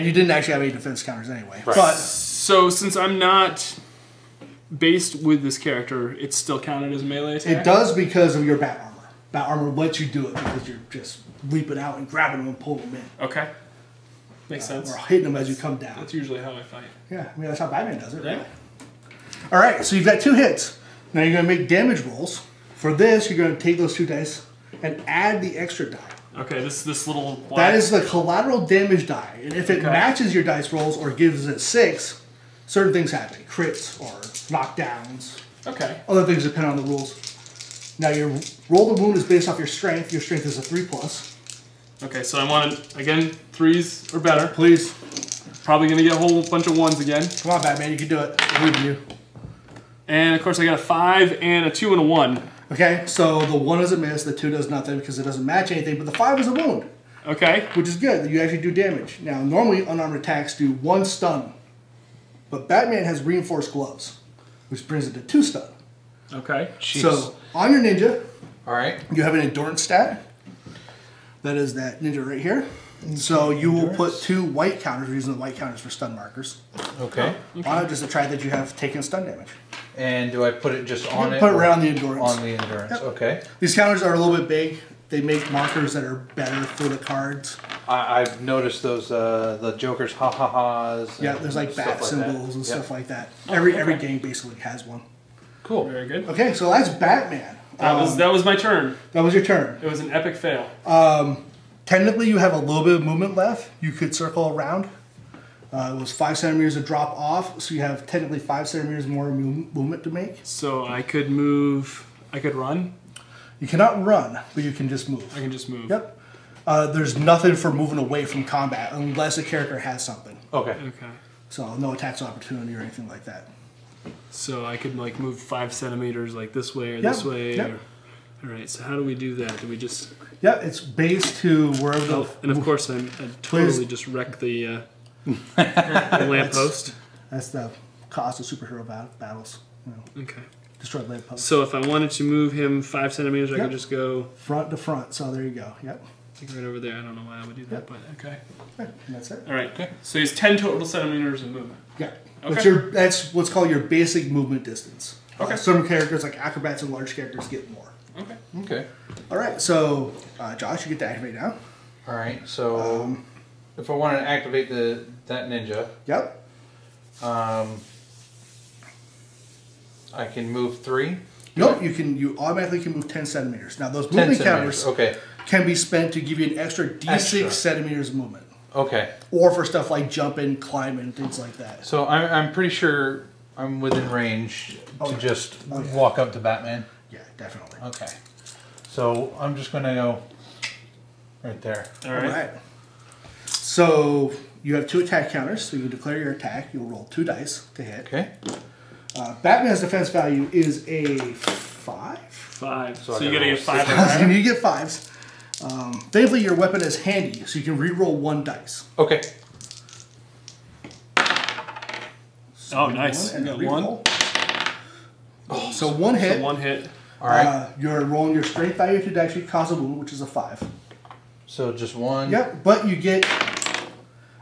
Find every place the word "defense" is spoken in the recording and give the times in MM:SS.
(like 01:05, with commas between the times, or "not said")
00:00, 03:19.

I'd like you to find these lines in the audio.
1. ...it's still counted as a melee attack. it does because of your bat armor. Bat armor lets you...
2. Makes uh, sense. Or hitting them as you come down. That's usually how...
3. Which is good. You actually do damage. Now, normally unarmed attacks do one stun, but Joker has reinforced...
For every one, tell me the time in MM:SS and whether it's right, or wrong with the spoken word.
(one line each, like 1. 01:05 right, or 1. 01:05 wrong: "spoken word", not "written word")
1. 00:06 right
2. 00:14 right
3. 00:57 wrong: "Batman", not "Joker".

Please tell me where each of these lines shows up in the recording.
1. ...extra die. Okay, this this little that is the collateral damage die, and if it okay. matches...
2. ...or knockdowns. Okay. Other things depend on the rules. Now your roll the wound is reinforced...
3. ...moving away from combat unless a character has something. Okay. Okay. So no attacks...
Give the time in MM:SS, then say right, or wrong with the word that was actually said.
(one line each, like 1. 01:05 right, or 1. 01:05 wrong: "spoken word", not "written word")
1. 00:25 right
2. 00:34 wrong: "based", not "reinforced"
3. 01:57 right.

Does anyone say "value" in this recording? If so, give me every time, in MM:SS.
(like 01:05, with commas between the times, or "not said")
03:20, 03:38.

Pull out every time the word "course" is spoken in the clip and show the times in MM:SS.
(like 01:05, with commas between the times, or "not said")
00:50, 02:12.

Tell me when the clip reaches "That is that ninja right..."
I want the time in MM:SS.
01:11.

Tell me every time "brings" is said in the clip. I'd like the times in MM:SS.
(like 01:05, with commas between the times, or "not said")
01:04.